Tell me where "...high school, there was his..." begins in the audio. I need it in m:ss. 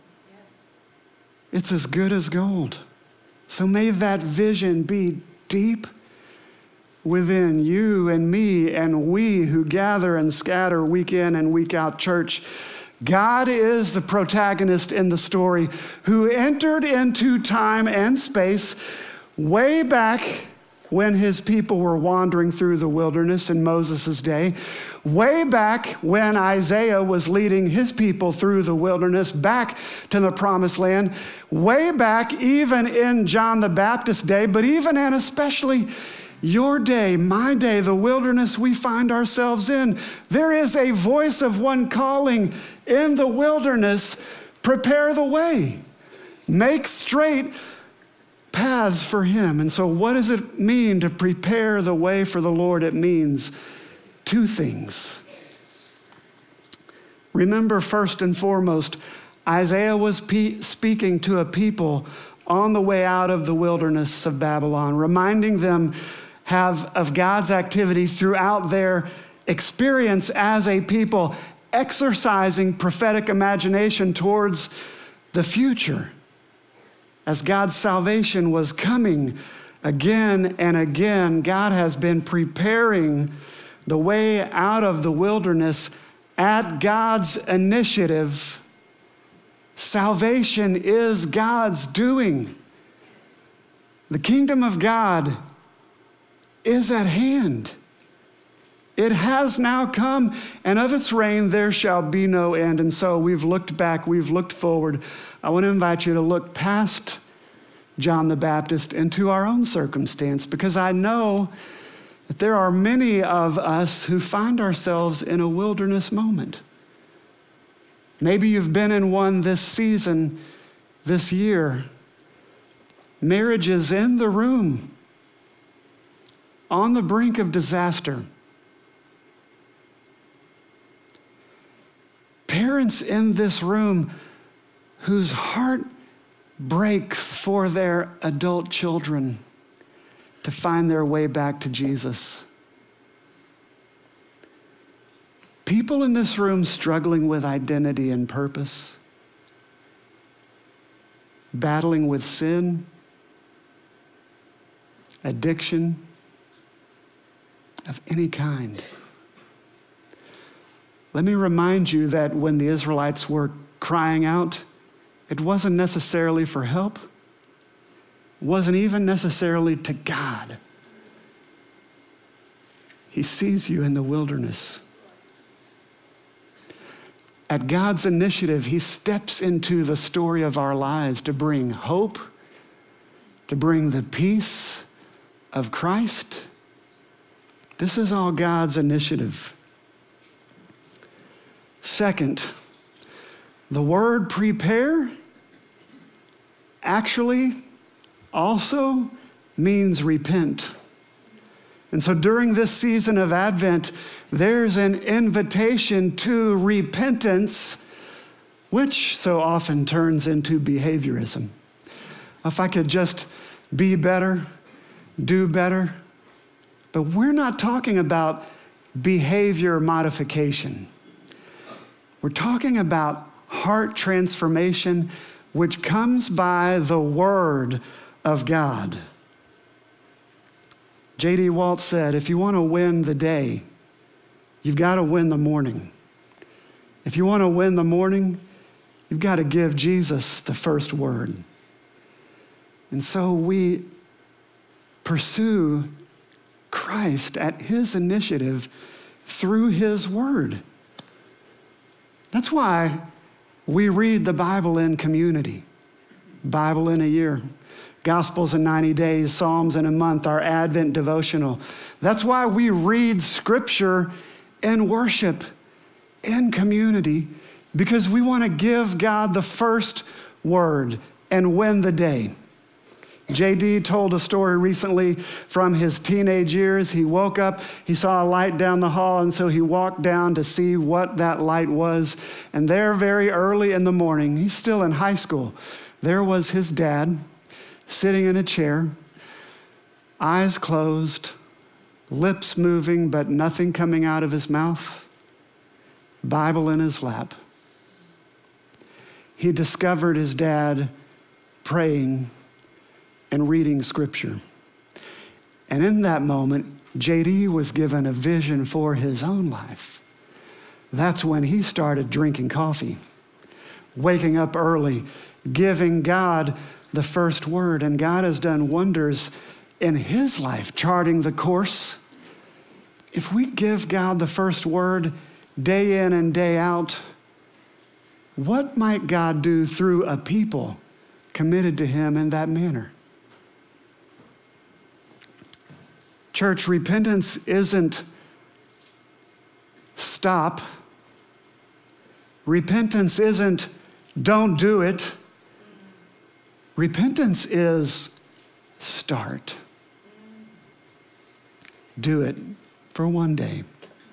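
4:44.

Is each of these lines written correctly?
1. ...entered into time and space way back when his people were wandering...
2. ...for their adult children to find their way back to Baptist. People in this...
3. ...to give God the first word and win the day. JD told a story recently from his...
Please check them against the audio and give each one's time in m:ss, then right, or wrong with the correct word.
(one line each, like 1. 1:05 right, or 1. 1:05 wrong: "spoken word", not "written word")
1. 0:16 right
2. 2:17 wrong: "Jesus", not "Baptist"
3. 4:28 right.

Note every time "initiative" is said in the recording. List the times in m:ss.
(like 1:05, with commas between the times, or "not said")
1:27, 2:58, 3:08, 4:07.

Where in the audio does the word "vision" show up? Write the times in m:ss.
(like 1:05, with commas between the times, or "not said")
0:04, 5:08.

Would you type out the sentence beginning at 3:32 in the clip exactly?
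If I could just be better, do better.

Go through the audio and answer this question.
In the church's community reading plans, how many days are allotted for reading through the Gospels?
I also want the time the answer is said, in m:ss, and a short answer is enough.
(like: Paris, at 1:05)
90 days, at 4:18.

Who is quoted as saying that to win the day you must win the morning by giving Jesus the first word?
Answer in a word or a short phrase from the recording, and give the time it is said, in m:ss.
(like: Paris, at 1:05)
J.D. Walt, at 3:51.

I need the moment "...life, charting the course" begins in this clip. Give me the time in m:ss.
5:20.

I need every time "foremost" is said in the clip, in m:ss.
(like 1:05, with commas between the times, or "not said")
0:58.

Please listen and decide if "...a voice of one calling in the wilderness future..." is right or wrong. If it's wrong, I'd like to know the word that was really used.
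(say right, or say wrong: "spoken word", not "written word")
wrong: "prepare", not "future".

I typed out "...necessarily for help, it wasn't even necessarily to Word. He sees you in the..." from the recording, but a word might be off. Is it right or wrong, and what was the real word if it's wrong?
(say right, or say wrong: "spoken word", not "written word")
wrong: "God", not "Word".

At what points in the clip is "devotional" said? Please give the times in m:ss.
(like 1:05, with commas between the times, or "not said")
4:20.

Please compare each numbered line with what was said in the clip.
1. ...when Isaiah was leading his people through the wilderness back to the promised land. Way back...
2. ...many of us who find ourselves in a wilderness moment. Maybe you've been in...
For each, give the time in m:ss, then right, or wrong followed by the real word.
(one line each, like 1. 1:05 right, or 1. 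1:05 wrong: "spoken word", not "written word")
1. 0:26 right
2. 1:52 right.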